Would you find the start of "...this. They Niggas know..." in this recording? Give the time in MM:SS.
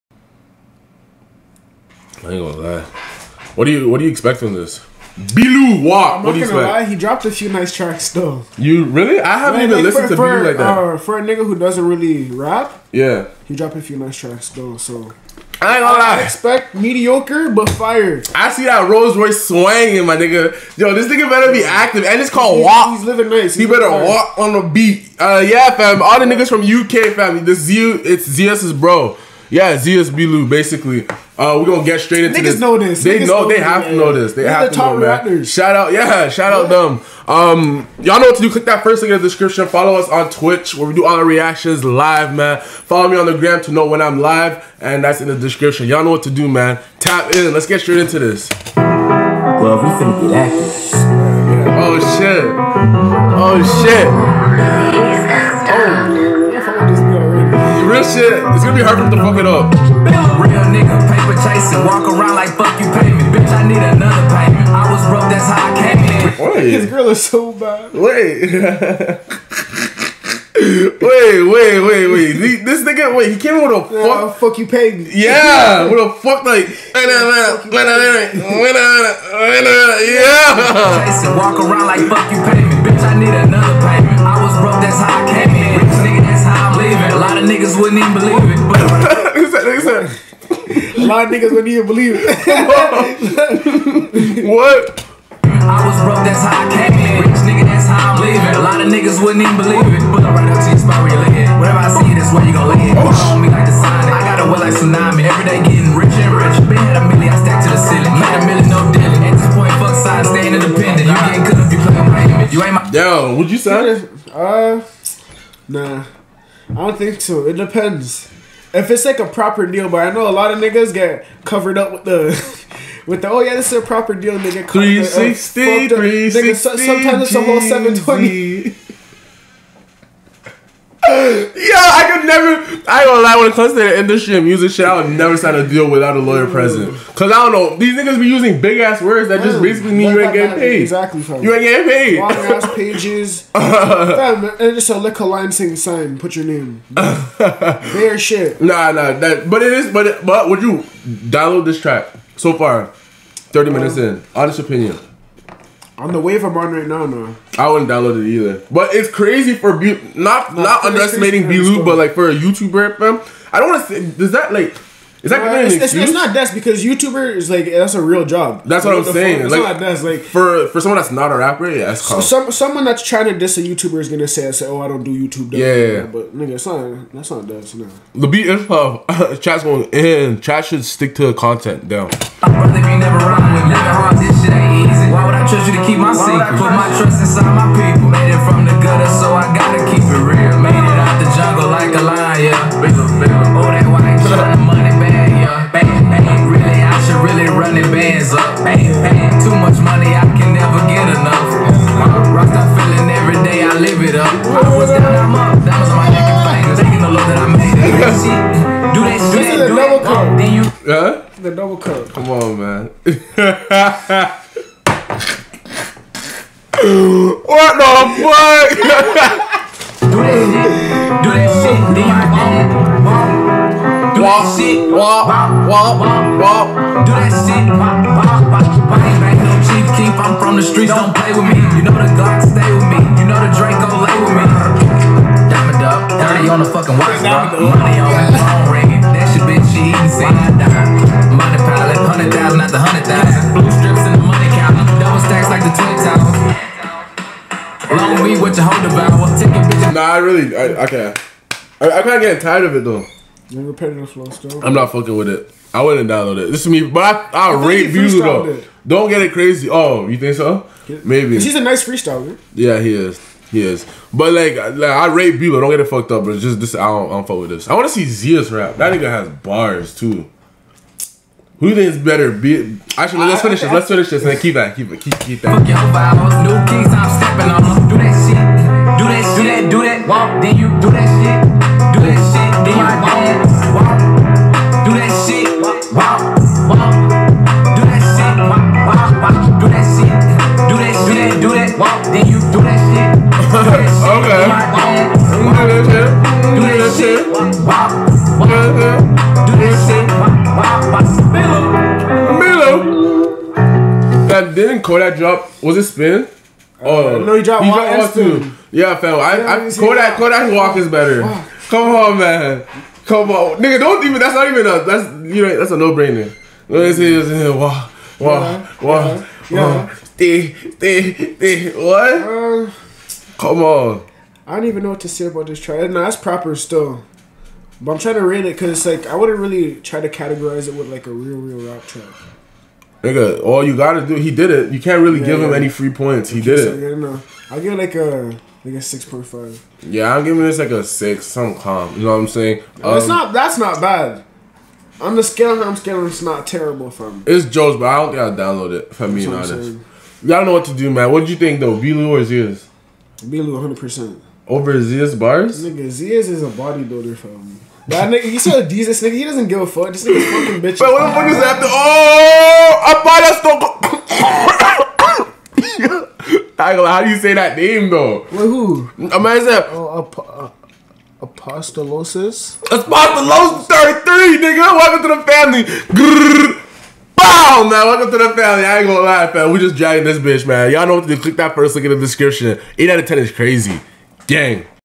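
00:32.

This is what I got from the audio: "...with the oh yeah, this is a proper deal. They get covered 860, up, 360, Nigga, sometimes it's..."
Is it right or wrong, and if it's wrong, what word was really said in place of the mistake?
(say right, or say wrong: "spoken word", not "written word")
wrong: "360", not "860".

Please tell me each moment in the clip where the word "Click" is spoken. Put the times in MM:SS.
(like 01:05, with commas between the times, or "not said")
00:38, 06:21.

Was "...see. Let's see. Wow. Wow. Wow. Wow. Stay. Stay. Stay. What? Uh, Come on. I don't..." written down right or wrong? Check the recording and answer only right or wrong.
right.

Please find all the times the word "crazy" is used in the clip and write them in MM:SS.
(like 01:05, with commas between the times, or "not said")
02:39, 04:19, 06:23.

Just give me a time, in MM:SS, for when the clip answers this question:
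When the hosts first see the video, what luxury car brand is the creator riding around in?
00:18.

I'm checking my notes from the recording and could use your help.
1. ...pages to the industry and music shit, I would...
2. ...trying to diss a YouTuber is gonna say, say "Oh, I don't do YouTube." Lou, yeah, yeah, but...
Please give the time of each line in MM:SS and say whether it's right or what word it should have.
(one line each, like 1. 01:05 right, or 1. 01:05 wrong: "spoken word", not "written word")
1. 02:13 wrong: "comes", not "pages"
2. 02:53 wrong: "Yeah", not "Lou".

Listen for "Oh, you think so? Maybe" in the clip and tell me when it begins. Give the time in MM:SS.
04:19.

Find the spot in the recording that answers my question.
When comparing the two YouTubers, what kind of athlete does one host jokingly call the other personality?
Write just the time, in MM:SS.
05:56.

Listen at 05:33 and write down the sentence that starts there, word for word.
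Nigga, all you gotta do, he did it.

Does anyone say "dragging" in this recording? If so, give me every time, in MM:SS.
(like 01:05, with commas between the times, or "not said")
06:19.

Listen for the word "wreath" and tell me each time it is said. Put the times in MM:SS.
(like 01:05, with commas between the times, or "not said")
not said.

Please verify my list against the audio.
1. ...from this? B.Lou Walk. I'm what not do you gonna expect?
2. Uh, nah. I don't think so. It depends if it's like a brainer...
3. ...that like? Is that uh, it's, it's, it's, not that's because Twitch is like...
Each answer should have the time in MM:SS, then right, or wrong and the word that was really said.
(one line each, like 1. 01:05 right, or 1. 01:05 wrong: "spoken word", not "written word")
1. 00:04 right
2. 01:54 wrong: "proper", not "brainer"
3. 02:44 wrong: "YouTuber", not "Twitch".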